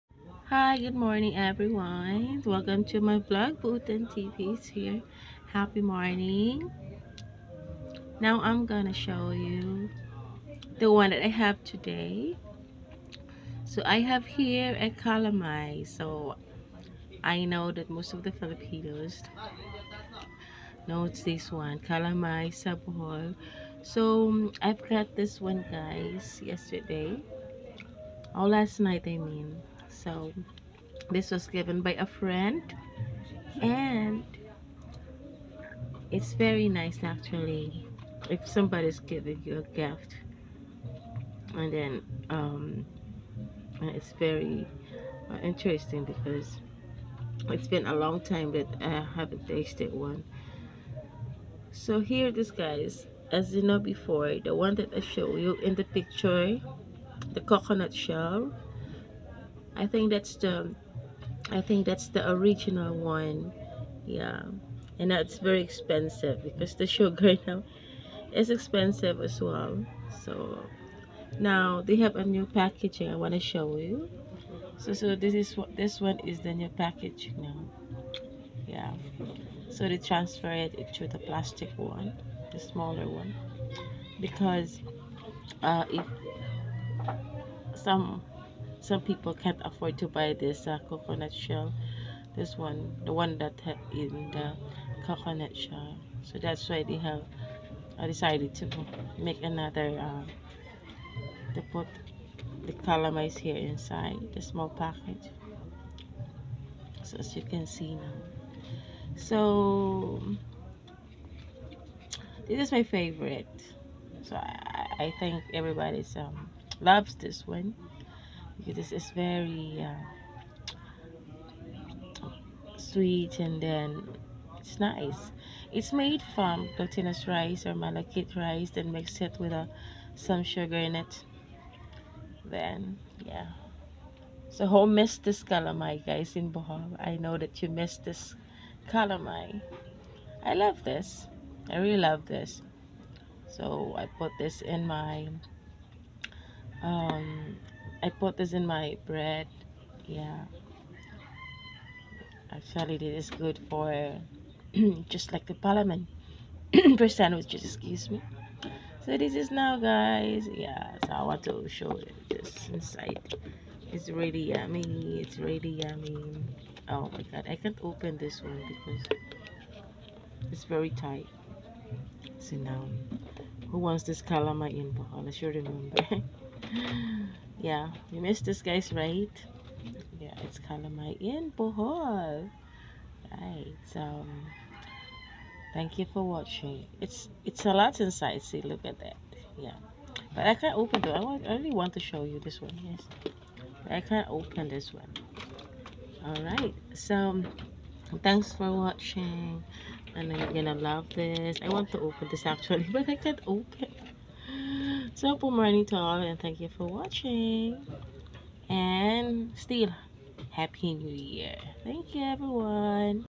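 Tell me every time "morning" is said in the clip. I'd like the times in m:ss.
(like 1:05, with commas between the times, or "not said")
0:00, 0:05, 3:25.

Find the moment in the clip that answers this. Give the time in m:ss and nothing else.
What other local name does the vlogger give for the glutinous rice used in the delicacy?
2:07.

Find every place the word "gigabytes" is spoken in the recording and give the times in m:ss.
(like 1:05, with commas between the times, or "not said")
not said.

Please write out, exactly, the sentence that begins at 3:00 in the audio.
Yeah, it's kind of my end, bohol.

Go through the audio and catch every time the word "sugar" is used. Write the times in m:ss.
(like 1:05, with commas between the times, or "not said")
1:06, 2:10.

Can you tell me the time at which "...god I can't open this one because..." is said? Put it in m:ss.
2:47.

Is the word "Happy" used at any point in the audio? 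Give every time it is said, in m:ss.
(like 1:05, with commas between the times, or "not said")
0:05, 3:30.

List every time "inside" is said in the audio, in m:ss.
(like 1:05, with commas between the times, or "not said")
1:43, 2:42, 3:08.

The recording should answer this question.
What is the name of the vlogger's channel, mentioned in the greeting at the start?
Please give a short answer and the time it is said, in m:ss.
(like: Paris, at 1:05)
Buotan TV, at 0:03.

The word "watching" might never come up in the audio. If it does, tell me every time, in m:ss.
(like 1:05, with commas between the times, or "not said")
3:06, 3:18, 3:26.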